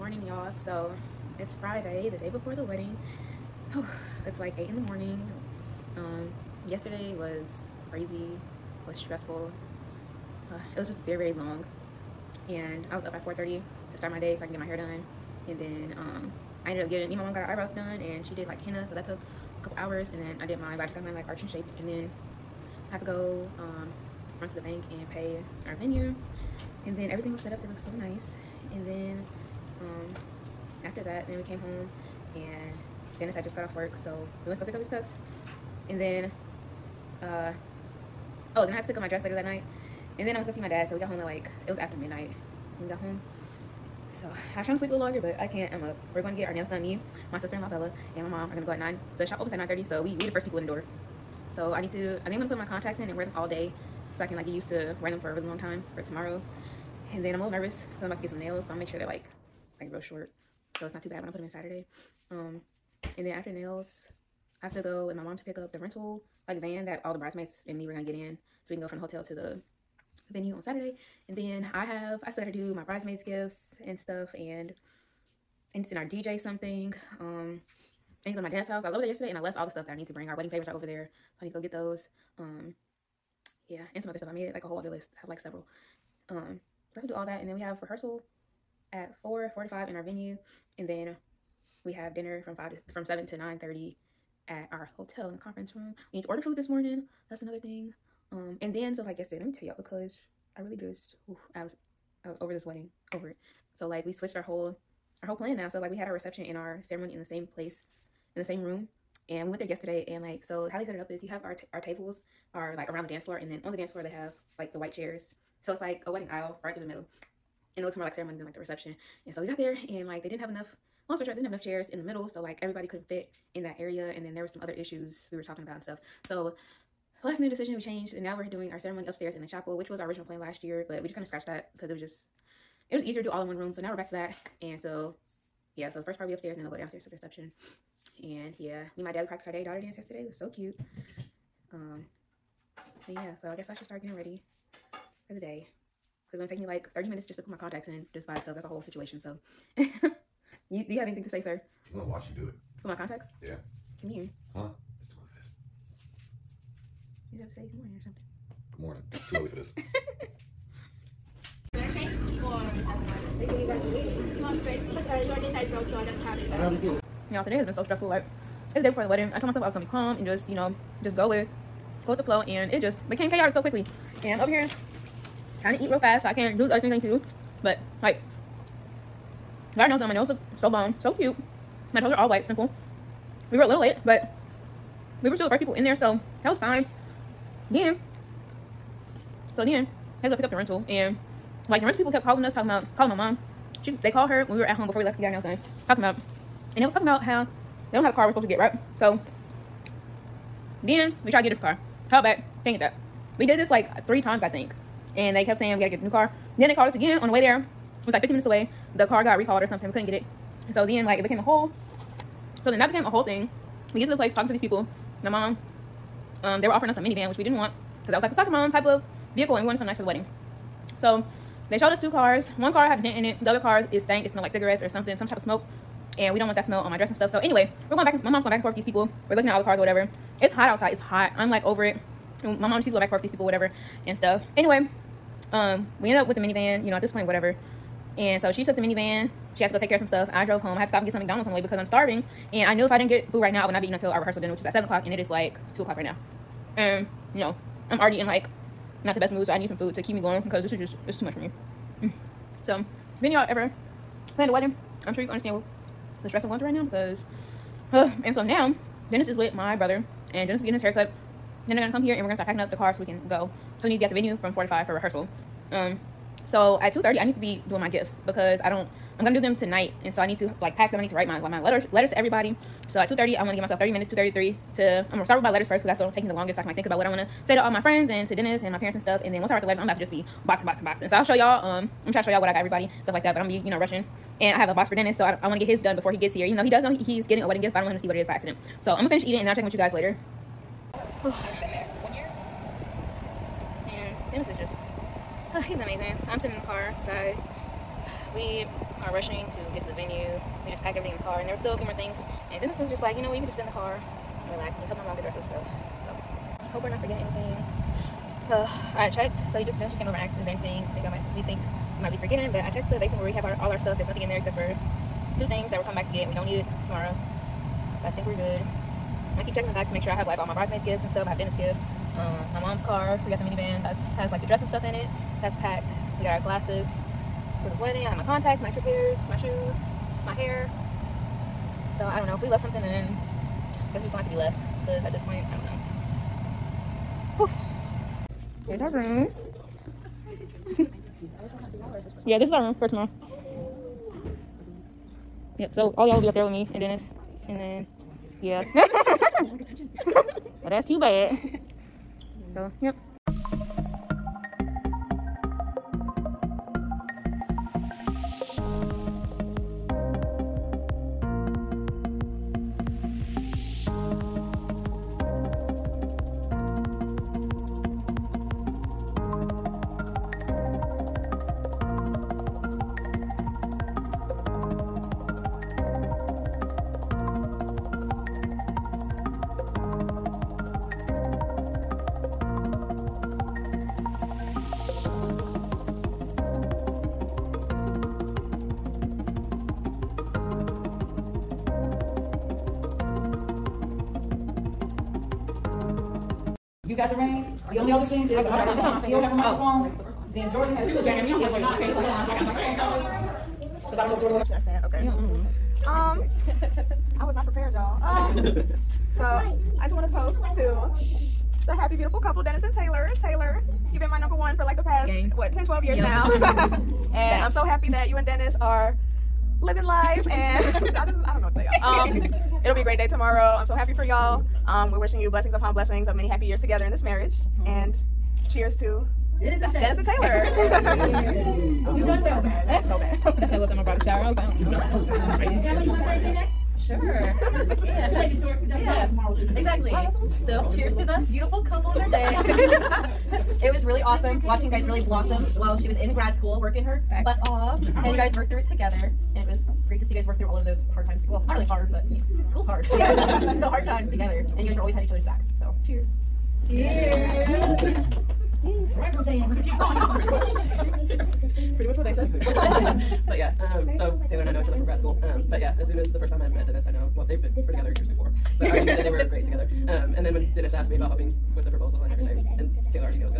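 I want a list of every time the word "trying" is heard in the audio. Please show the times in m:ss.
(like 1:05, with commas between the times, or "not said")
0:44, 2:55, 4:42.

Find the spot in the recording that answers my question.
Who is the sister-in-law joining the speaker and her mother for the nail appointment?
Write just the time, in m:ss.
0:47.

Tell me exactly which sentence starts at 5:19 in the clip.
I keep checking the back to make sure I have like all my bridesmaids gifts and stuff.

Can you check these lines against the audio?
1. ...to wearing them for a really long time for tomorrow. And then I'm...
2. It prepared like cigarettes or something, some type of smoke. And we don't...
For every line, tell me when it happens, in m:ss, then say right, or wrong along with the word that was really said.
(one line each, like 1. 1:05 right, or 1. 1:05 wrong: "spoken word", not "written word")
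1. 0:54 right
2. 3:44 wrong: "smelled", not "prepared".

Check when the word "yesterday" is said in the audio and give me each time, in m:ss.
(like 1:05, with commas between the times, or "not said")
0:06, 1:19, 1:39, 1:49, 2:19.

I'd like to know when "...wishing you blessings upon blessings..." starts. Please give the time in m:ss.
7:04.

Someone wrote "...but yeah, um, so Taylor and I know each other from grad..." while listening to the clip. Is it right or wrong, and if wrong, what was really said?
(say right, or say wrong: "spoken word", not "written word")
right.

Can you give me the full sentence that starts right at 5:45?
Yep, so all y'all will be up there with me and Dennis.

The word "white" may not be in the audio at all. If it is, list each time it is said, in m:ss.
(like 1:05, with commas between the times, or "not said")
1:54, 3:02.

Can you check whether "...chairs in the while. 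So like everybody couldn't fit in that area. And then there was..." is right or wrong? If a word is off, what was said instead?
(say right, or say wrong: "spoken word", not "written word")
wrong: "middle", not "while".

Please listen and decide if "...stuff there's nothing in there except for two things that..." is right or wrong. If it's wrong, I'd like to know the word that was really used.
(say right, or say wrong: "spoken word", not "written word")
right.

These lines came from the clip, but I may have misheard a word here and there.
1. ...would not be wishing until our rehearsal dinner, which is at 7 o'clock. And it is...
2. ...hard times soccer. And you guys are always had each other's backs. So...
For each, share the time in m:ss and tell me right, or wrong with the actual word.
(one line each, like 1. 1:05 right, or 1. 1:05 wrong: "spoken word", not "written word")
1. 4:03 wrong: "eating", not "wishing"
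2. 7:33 wrong: "together", not "soccer".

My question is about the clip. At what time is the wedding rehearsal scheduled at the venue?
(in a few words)
4:45.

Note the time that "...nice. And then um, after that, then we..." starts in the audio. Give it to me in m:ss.
0:27.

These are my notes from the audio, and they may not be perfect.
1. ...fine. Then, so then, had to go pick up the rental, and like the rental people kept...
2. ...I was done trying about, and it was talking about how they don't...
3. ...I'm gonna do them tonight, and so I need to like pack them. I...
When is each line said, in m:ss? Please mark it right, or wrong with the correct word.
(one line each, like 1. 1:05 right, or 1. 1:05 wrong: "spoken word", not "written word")
1. 3:06 right
2. 3:15 wrong: "talking", not "trying"
3. 4:29 right.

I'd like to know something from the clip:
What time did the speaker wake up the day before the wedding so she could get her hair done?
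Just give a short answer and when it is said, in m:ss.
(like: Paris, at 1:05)
4:30, at 0:13.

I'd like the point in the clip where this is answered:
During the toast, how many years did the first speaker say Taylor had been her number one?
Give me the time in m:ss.
6:55.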